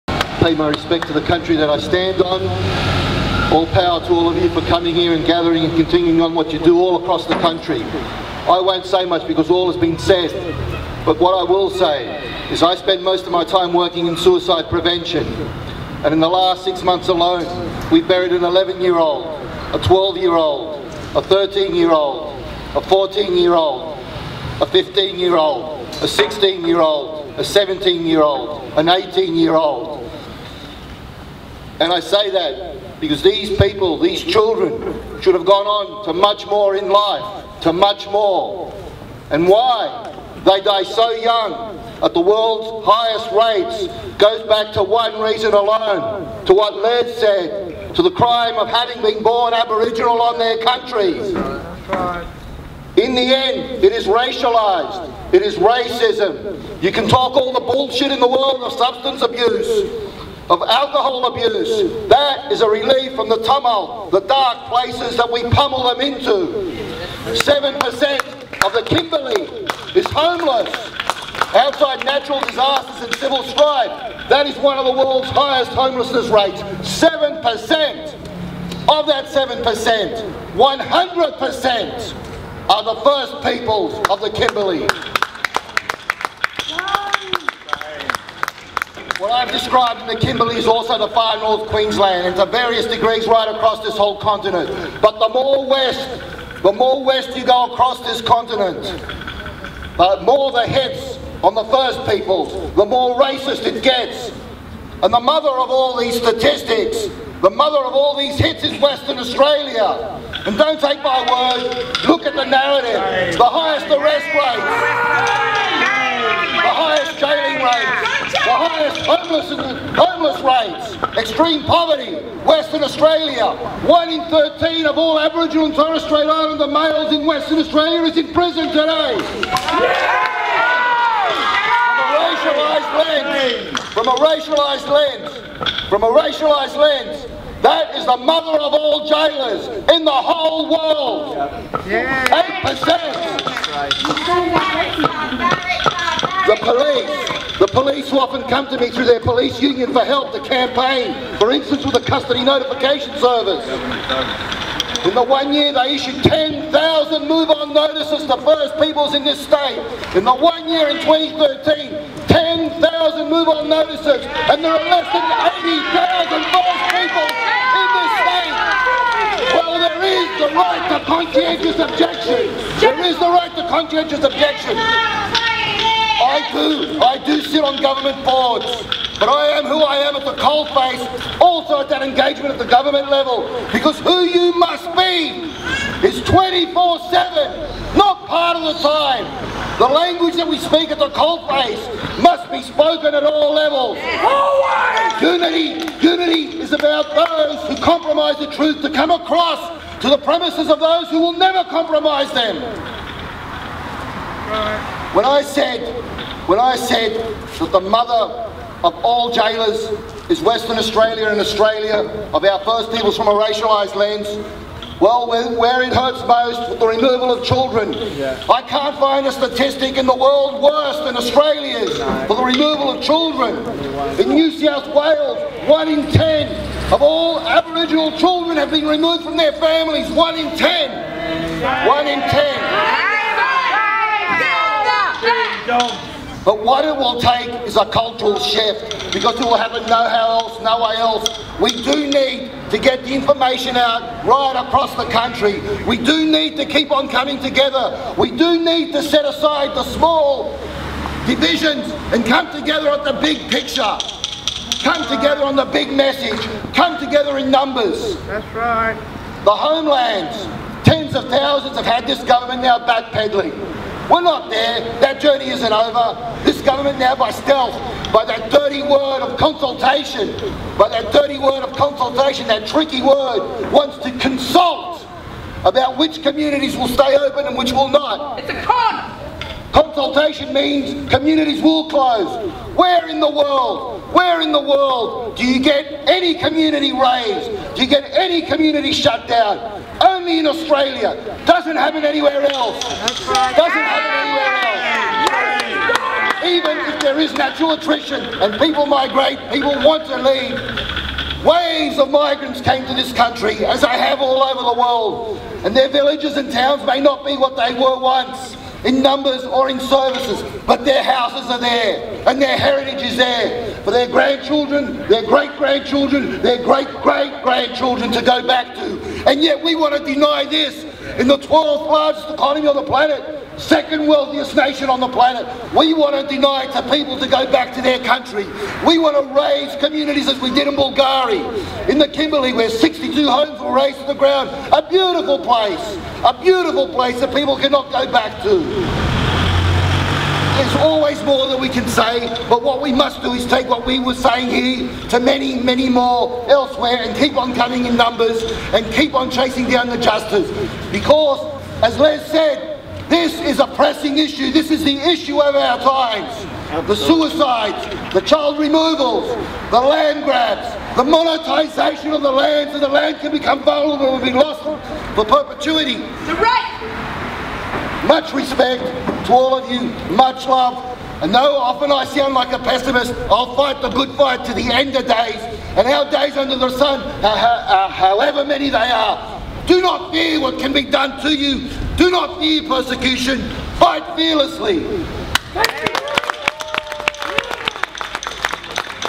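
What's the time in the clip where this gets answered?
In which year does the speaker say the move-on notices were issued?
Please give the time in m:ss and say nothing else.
2:40.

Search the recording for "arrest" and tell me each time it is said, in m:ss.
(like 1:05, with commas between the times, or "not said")
1:53.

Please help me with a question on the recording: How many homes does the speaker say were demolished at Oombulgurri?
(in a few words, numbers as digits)
62.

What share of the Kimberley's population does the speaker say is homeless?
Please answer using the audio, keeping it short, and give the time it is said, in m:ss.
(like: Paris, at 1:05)
7%, at 1:07.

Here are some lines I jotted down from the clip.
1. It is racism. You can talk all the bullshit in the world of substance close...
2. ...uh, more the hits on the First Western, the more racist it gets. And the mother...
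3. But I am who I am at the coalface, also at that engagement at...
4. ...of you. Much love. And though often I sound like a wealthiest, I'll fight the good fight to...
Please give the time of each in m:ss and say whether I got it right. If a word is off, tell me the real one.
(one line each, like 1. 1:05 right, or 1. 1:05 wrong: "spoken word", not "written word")
1. 0:55 wrong: "abuse", not "close"
2. 1:40 wrong: "Peoples", not "Western"
3. 2:59 right
4. 6:09 wrong: "pessimist", not "wealthiest".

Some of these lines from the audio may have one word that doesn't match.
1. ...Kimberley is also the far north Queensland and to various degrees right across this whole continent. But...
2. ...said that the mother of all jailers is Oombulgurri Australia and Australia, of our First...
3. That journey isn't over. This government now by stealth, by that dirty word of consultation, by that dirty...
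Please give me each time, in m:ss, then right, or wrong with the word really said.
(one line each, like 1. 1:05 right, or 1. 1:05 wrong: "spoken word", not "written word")
1. 1:30 right
2. 3:26 wrong: "Western", not "Oombulgurri"
3. 4:24 right.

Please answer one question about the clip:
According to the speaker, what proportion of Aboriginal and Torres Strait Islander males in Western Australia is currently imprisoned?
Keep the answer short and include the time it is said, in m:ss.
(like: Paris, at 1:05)
1 in 13, at 2:03.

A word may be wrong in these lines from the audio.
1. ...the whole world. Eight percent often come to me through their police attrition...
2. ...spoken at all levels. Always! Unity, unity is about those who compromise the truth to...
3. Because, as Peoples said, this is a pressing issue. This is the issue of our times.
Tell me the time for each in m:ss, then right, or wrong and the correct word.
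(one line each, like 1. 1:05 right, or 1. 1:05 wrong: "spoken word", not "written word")
1. 2:20 wrong: "union", not "attrition"
2. 3:12 right
3. 5:50 wrong: "Les", not "Peoples".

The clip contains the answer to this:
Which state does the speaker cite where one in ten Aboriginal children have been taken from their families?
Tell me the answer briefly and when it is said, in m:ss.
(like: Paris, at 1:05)
New South Wales, at 3:44.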